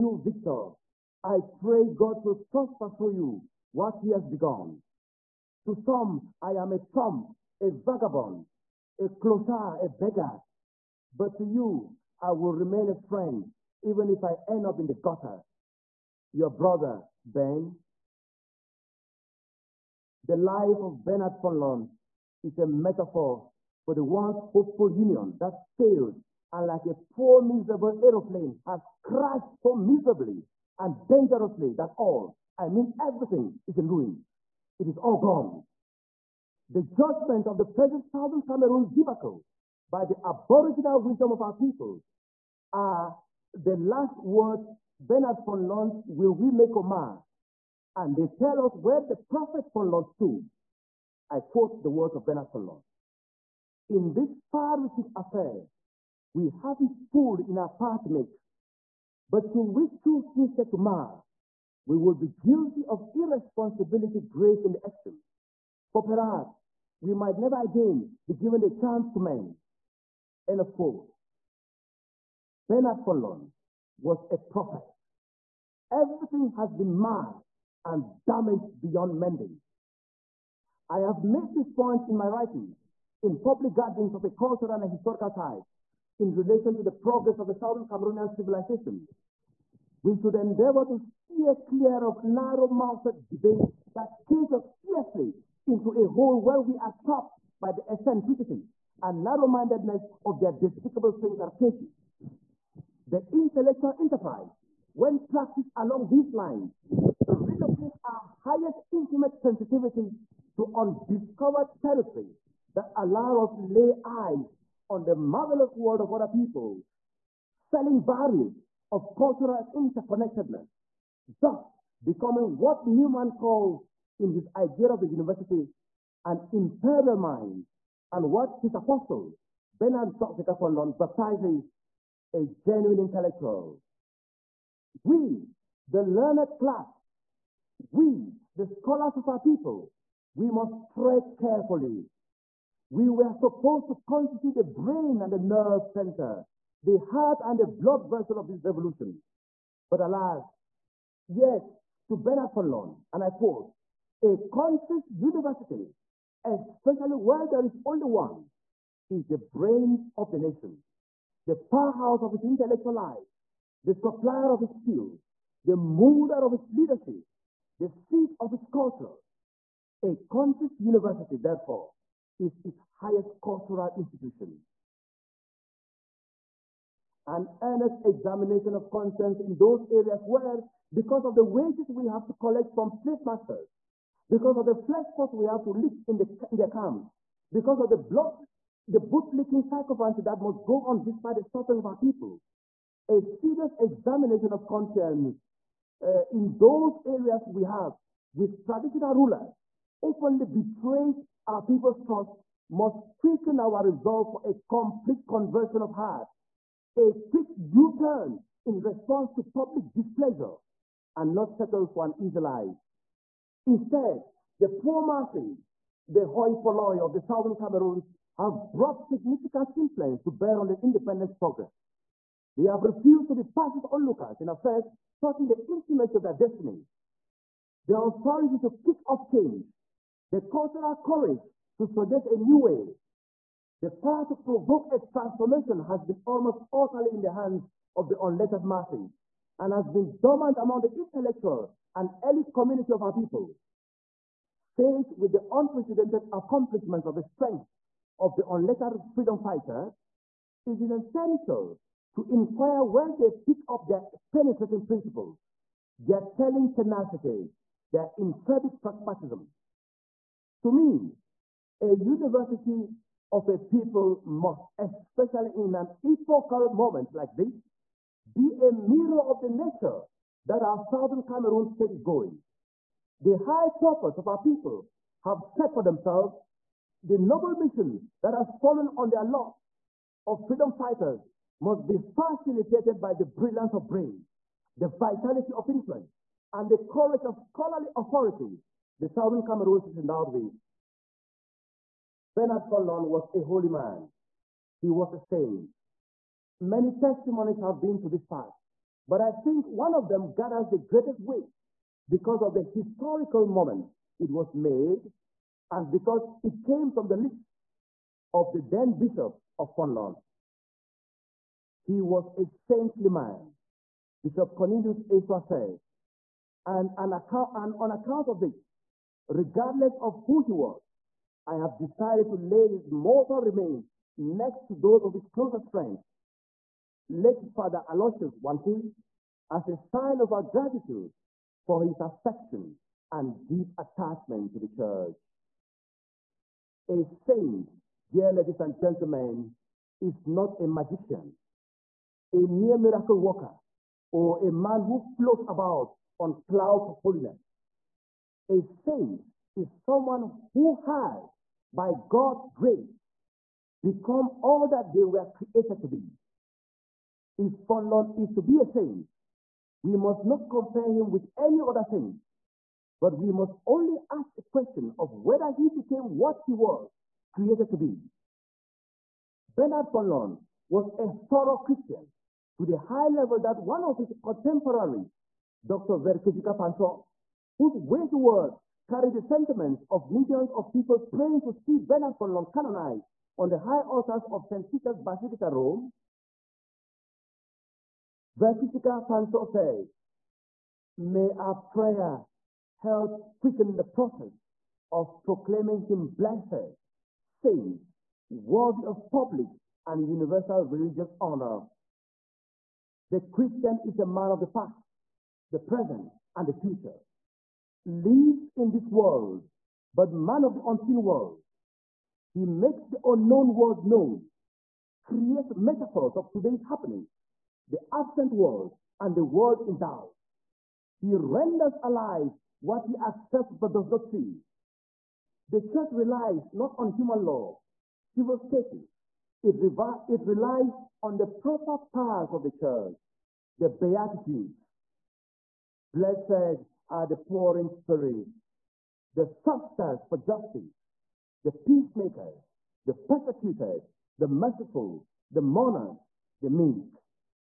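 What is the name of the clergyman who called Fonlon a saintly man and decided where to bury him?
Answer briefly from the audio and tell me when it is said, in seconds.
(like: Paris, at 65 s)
Bishop Cornelius Esua, at 314 s.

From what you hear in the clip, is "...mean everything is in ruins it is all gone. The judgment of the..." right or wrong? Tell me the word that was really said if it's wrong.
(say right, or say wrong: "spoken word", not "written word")
right.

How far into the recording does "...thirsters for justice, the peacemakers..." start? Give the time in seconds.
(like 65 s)
439 s.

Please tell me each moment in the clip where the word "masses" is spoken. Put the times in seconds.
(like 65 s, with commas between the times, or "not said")
215 s, 238 s.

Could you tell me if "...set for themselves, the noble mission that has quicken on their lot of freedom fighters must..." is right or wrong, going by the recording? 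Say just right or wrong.
wrong.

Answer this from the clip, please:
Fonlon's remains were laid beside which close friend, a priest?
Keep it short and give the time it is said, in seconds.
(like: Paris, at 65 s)
Father Aloysius Wankui, at 327 s.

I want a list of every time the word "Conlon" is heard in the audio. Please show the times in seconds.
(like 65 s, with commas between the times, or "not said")
309 s.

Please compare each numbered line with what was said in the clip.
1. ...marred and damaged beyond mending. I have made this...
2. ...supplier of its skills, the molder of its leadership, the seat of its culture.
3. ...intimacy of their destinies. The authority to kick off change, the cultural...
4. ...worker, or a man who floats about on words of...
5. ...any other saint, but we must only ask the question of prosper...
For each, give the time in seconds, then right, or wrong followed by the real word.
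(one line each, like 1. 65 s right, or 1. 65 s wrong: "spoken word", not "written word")
1. 76 s right
2. 163 s right
3. 225 s right
4. 343 s wrong: "clouds", not "words"
5. 361 s wrong: "whether", not "prosper".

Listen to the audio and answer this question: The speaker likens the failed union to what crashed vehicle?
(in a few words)
Aeroplane.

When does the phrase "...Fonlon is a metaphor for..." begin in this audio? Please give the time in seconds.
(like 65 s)
21 s.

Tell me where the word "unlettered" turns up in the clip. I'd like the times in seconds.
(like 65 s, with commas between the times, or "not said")
238 s, 248 s.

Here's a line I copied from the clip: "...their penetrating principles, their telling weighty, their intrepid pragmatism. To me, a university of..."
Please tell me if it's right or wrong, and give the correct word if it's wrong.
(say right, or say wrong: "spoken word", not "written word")
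wrong: "tenacity", not "weighty".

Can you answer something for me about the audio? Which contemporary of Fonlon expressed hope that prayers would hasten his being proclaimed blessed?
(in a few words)
Dr. Verkijika Fanso.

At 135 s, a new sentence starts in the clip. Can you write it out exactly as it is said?
We, the learned class, we, the scholars of our people, we must tread carefully.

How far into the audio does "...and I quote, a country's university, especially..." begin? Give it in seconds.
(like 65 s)
153 s.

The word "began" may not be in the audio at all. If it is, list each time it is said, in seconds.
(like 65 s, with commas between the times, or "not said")
not said.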